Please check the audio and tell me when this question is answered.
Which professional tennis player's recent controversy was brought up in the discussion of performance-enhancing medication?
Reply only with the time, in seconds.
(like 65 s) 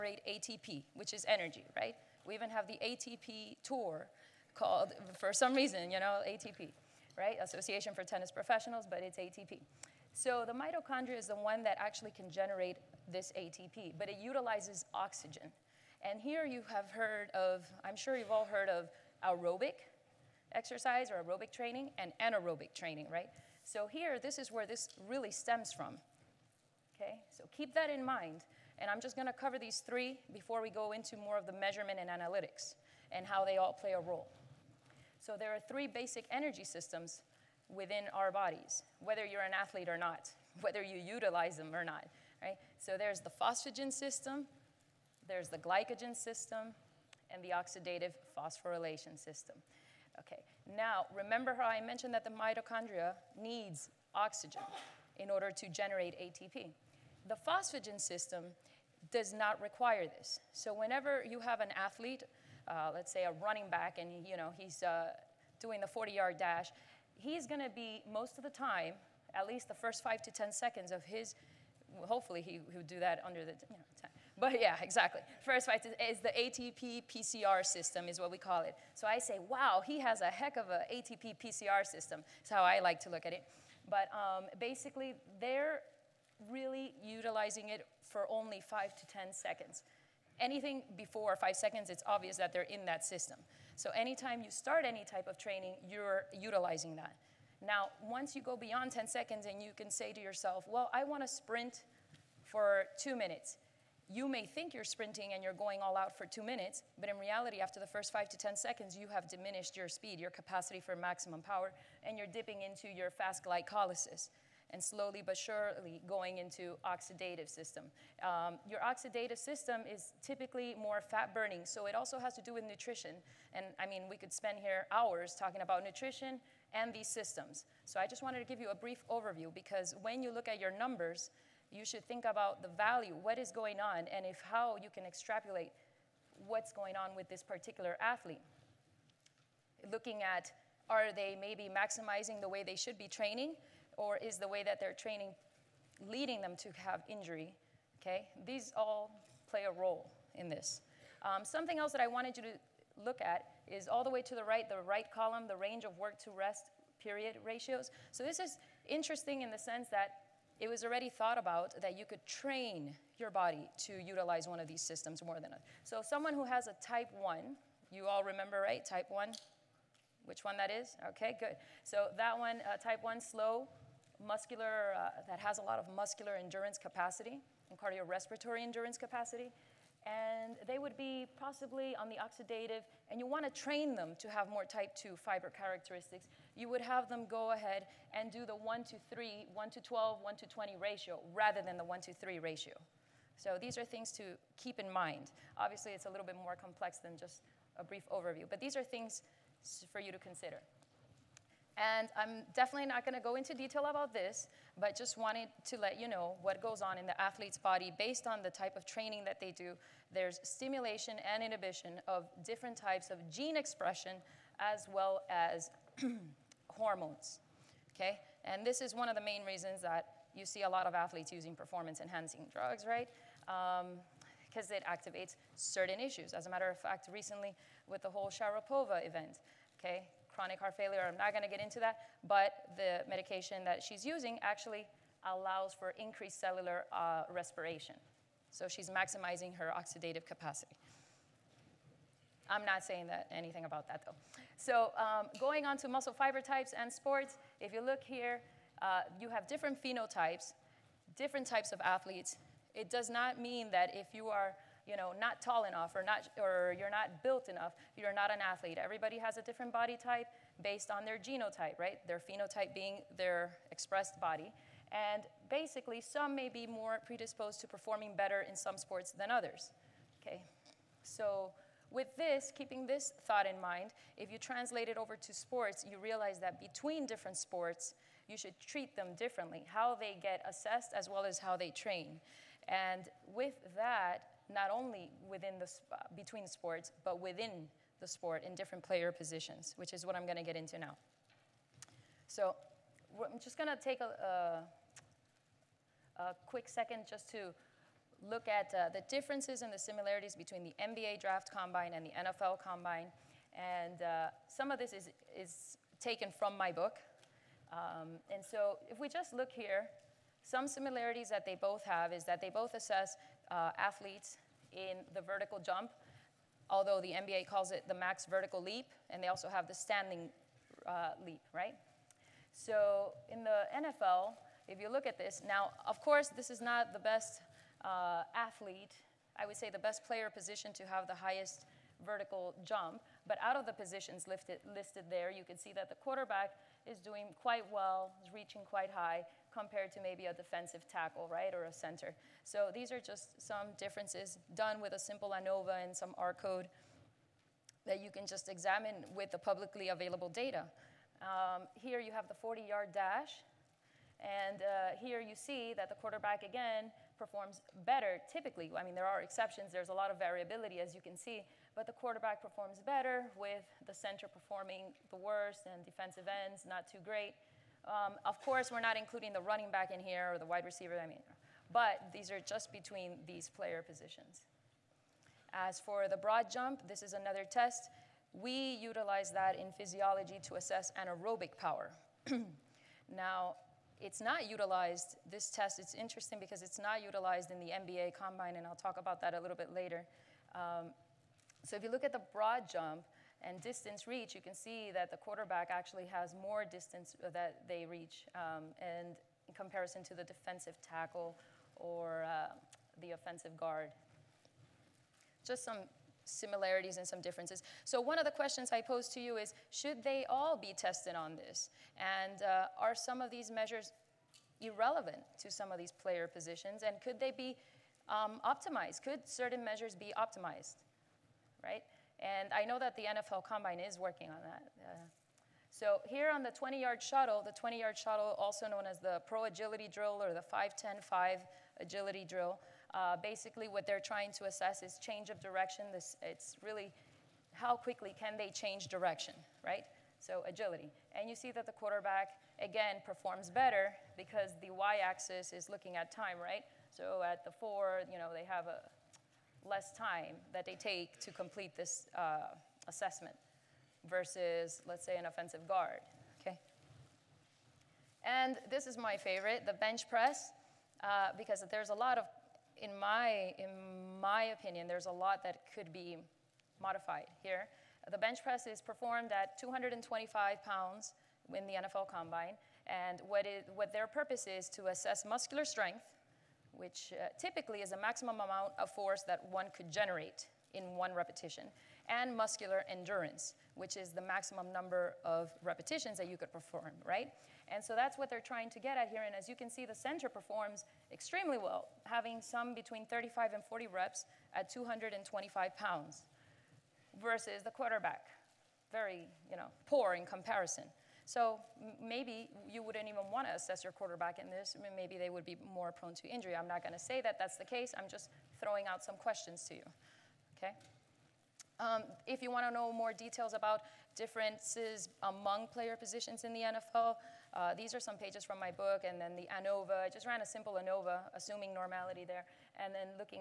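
228 s.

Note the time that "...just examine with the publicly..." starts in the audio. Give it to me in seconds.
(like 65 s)
348 s.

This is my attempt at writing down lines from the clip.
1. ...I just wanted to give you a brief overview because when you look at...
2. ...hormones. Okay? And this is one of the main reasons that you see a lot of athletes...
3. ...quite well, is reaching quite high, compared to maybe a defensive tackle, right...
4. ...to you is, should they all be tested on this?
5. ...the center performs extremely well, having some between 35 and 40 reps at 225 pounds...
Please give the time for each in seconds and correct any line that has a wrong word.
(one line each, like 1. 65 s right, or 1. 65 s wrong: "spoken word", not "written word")
1. 128 s right
2. 216 s right
3. 337 s right
4. 409 s right
5. 489 s right.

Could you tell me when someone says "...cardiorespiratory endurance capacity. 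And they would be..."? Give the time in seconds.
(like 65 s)
177 s.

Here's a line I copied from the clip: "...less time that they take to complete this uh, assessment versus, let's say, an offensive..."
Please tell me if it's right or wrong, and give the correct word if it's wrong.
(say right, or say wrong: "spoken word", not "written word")
right.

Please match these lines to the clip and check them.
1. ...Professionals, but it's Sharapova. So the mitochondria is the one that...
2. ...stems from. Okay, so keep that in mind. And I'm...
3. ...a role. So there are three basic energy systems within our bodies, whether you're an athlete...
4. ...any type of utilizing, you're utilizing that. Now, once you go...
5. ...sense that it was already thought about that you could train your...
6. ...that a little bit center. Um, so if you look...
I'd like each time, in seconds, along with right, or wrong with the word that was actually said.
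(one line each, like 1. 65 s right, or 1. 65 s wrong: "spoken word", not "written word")
1. 8 s wrong: "ATP", not "Sharapova"
2. 25 s right
3. 33 s right
4. 94 s wrong: "training", not "utilizing"
5. 159 s right
6. 389 s wrong: "later", not "center".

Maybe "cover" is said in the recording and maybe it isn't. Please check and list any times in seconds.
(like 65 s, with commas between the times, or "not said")
29 s.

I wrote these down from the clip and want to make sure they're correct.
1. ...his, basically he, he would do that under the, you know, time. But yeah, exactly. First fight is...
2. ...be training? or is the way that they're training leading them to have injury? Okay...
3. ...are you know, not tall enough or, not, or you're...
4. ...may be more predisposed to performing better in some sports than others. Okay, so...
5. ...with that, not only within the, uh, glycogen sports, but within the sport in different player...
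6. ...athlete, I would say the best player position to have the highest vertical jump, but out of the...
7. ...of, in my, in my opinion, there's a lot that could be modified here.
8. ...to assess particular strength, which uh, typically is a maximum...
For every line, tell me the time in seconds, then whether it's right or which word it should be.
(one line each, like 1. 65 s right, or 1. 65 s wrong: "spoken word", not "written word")
1. 71 s wrong: "hopefully", not "basically"
2. 142 s right
3. 254 s right
4. 266 s right
5. 283 s wrong: "between", not "glycogen"
6. 328 s right
7. 462 s right
8. 474 s wrong: "muscular", not "particular".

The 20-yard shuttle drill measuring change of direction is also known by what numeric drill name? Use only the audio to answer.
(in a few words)
5-10-5 Agility Drill.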